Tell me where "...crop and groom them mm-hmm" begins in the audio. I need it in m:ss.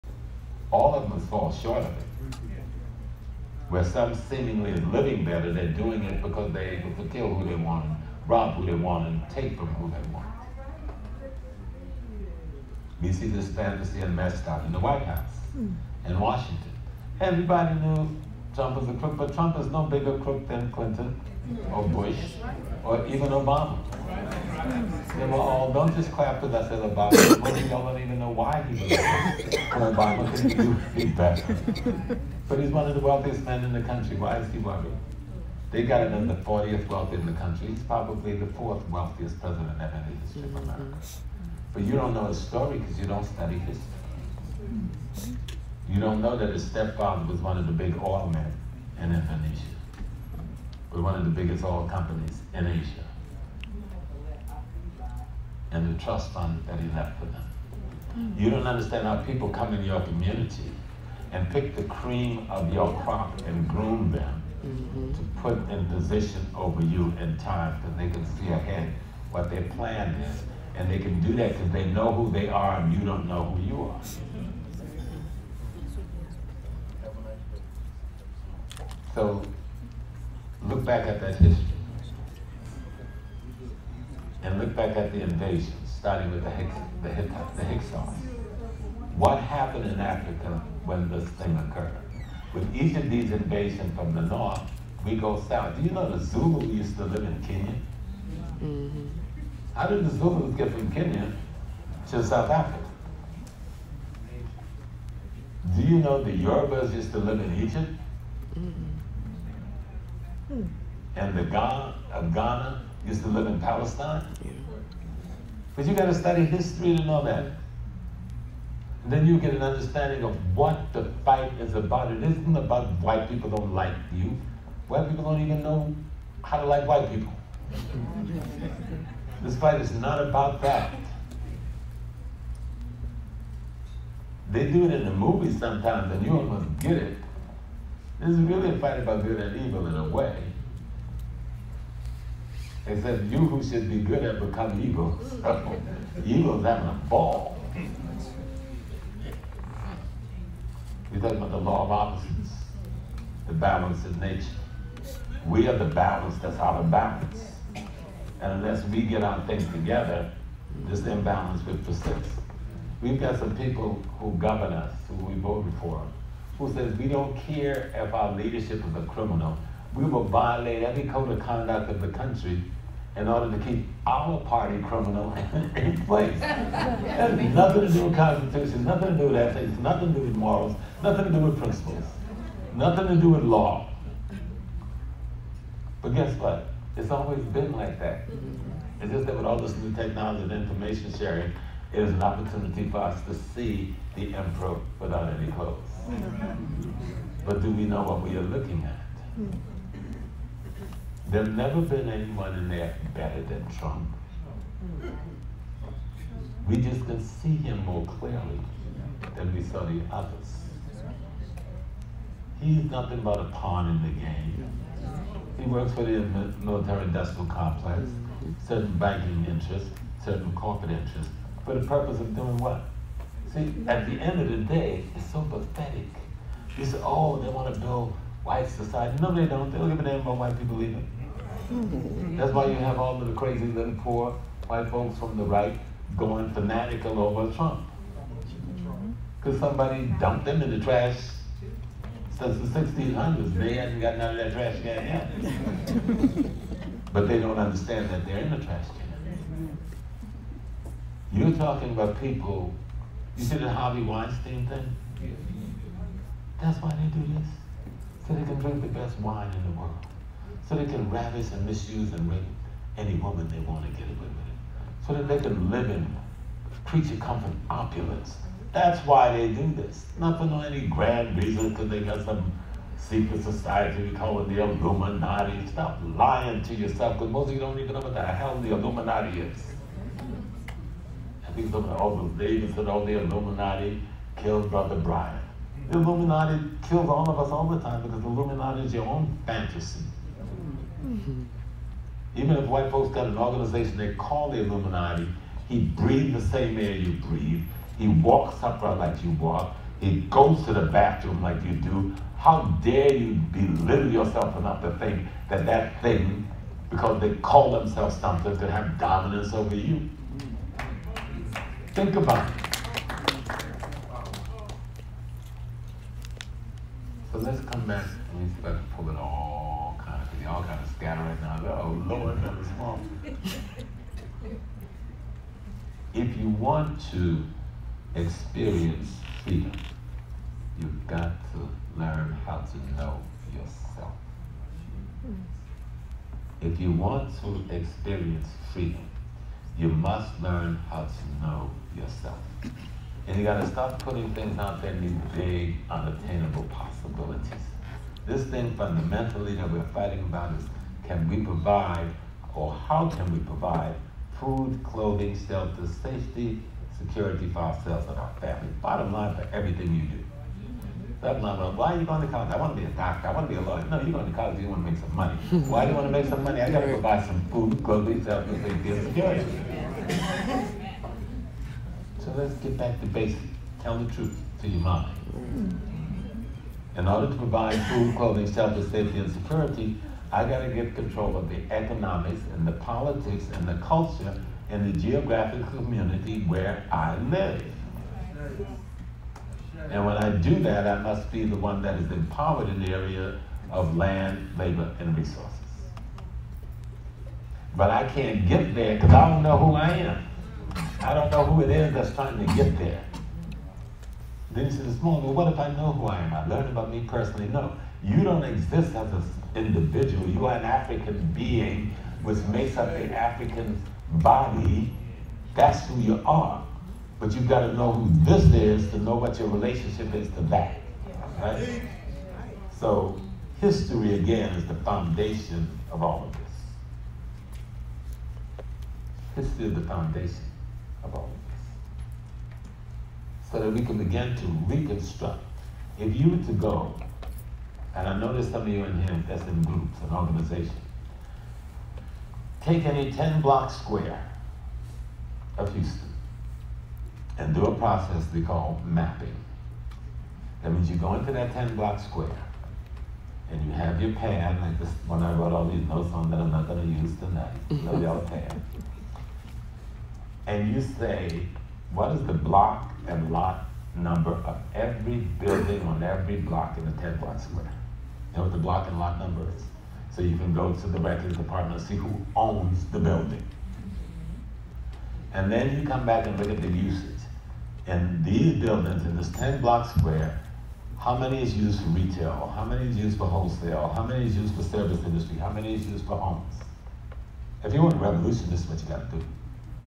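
1:03.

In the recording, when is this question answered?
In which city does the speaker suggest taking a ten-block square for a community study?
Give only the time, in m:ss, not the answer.
7:25.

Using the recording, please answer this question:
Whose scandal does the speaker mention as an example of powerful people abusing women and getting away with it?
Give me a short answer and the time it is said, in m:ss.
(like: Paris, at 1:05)
Harvey Weinstein, at 4:13.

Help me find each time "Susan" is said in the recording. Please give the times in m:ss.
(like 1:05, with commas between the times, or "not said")
not said.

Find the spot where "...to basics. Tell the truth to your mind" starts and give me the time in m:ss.
6:12.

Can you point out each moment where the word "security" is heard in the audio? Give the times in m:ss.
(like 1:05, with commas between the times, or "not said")
5:56, 6:09, 6:19.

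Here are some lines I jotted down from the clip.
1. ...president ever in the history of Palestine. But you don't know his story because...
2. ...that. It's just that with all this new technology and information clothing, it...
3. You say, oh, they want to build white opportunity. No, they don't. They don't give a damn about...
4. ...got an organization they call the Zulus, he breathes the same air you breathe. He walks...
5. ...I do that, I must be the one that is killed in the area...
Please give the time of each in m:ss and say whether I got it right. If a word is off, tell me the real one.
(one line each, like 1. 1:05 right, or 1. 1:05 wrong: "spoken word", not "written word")
1. 0:39 wrong: "America", not "Palestine"
2. 3:07 wrong: "sharing", not "clothing"
3. 3:46 wrong: "society", not "opportunity"
4. 4:53 wrong: "Illuminati", not "Zulus"
5. 6:30 wrong: "empowered", not "killed".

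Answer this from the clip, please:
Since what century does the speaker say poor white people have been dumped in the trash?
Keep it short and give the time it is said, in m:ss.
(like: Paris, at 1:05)
1600s, at 4:02.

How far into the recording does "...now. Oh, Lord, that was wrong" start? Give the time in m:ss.
5:21.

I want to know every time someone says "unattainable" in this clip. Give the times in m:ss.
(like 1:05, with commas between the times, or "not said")
5:45.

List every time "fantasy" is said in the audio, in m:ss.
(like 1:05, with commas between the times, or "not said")
0:13, 4:49.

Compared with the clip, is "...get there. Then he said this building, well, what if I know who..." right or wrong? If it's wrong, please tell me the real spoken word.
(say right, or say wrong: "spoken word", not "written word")
wrong: "morning", not "building".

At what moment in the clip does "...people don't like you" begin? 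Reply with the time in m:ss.
2:03.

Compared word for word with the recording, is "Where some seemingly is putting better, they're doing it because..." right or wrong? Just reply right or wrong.
wrong.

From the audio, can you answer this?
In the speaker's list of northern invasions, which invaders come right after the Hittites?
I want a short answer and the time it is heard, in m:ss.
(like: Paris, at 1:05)
Hyksos, at 1:27.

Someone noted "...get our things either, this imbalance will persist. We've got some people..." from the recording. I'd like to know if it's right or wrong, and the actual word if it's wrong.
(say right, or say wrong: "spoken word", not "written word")
wrong: "together", not "either".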